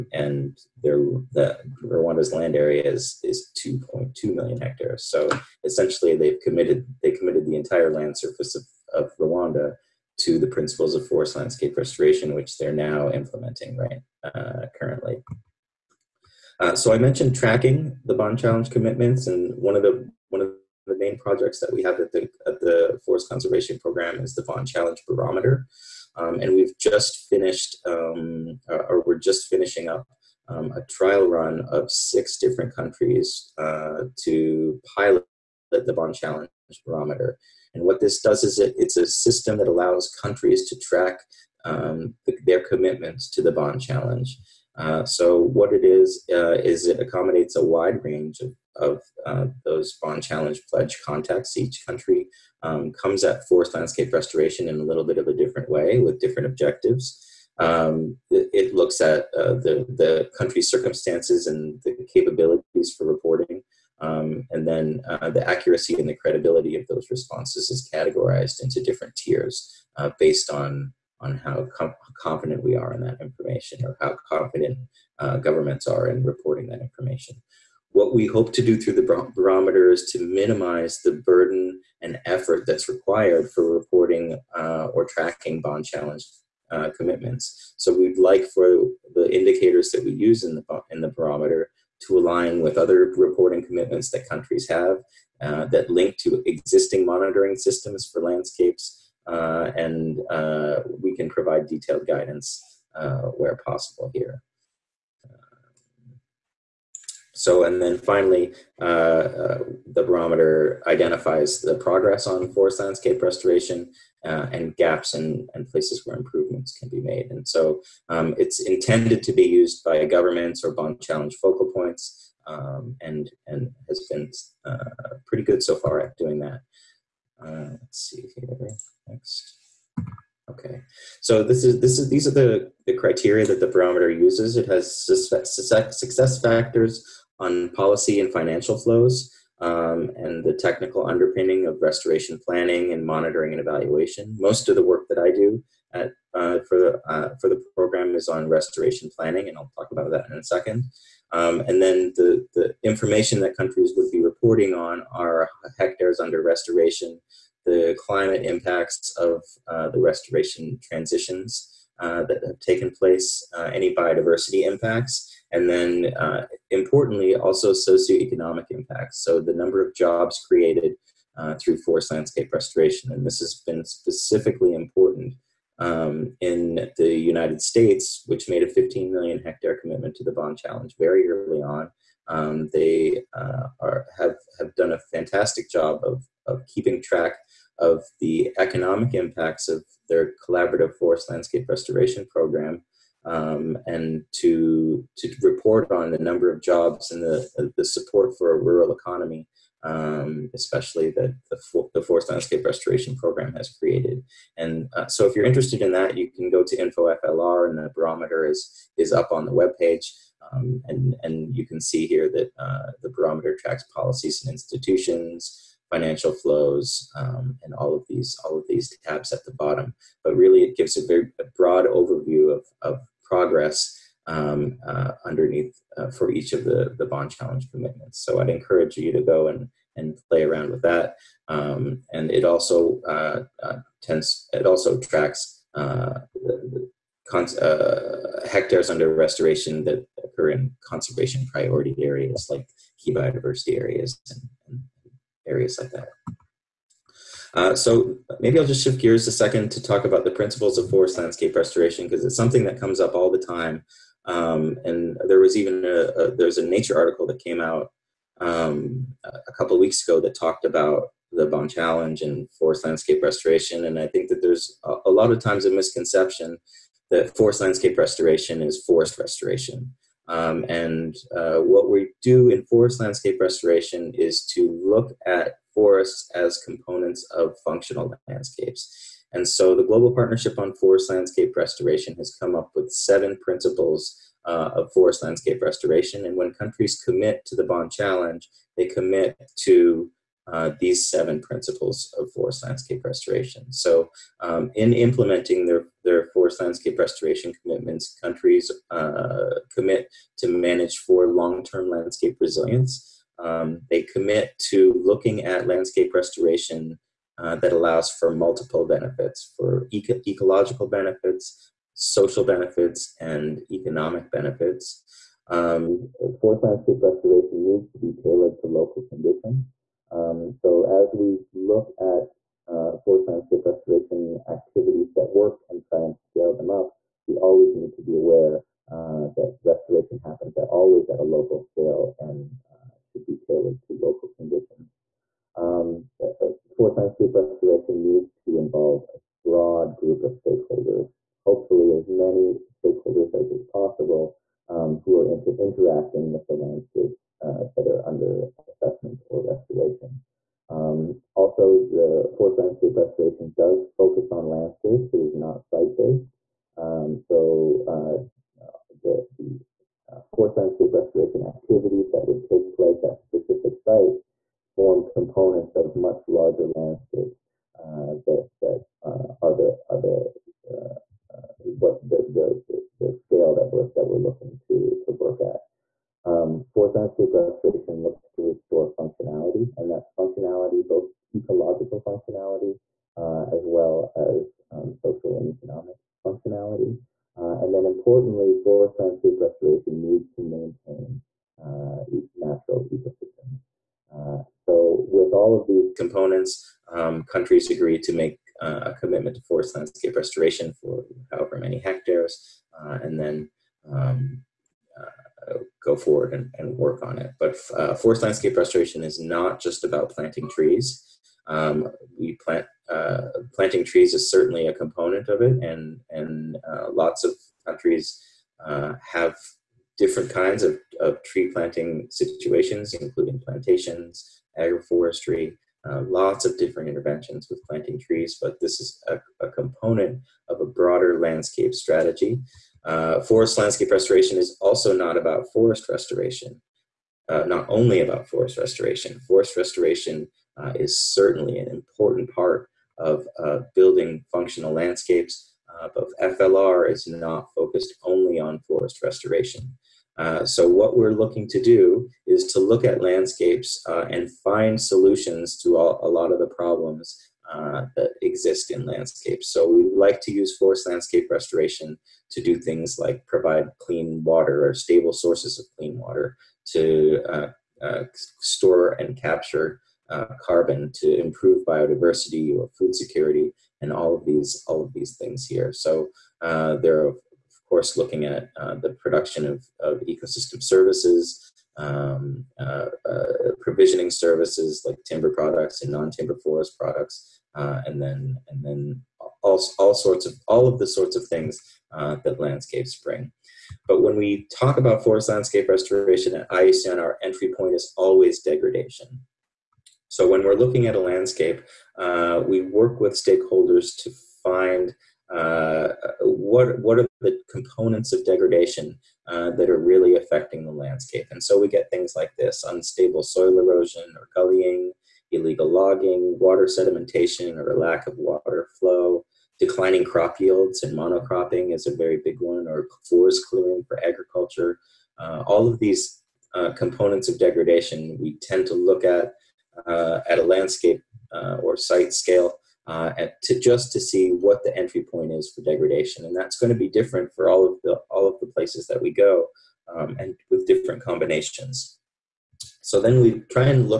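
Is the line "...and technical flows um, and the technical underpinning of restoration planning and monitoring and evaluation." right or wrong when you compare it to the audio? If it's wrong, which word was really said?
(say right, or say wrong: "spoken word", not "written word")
wrong: "financial", not "technical".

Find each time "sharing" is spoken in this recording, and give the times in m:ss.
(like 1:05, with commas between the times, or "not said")
not said.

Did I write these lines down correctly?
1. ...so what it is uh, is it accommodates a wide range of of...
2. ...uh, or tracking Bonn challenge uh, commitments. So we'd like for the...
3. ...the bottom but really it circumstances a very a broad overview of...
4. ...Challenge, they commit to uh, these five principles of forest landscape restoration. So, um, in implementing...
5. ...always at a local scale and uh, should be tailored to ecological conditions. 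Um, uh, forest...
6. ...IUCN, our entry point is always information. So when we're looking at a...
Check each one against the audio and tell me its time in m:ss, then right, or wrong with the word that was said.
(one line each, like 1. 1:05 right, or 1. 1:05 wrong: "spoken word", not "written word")
1. 0:45 right
2. 1:24 right
3. 3:39 wrong: "gives", not "circumstances"
4. 4:47 wrong: "seven", not "five"
5. 5:30 wrong: "local", not "ecological"
6. 8:16 wrong: "degradation", not "information".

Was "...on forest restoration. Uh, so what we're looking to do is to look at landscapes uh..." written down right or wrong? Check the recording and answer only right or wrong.
right.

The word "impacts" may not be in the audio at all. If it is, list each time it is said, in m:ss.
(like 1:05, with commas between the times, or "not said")
2:38, 2:44, 2:48, 3:09.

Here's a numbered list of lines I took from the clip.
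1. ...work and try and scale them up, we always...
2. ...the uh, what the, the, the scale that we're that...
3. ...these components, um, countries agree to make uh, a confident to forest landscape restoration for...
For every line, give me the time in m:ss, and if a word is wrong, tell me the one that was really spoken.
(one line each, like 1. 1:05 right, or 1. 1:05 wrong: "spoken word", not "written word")
1. 5:25 right
2. 6:10 right
3. 6:35 wrong: "commitment", not "confident".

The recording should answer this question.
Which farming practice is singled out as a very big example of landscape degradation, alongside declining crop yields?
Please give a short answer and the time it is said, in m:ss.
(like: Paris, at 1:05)
Monocropping, at 8:40.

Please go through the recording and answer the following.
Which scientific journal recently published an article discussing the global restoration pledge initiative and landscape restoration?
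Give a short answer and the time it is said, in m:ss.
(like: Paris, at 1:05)
Nature, at 4:16.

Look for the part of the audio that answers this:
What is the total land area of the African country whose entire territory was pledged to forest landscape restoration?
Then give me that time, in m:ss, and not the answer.
0:03.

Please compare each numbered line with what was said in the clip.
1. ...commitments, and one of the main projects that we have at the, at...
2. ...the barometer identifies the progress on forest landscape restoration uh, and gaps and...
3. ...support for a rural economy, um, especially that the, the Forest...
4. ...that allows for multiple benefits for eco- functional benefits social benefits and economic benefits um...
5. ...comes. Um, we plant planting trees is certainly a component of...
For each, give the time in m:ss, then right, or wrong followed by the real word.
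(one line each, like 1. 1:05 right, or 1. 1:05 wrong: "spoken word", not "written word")
1. 0:18 right
2. 1:49 right
3. 3:17 right
4. 5:07 wrong: "ecological", not "functional"
5. 6:50 wrong: "trees", not "comes".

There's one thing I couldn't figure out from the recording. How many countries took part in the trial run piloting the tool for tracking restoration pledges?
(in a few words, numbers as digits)
6.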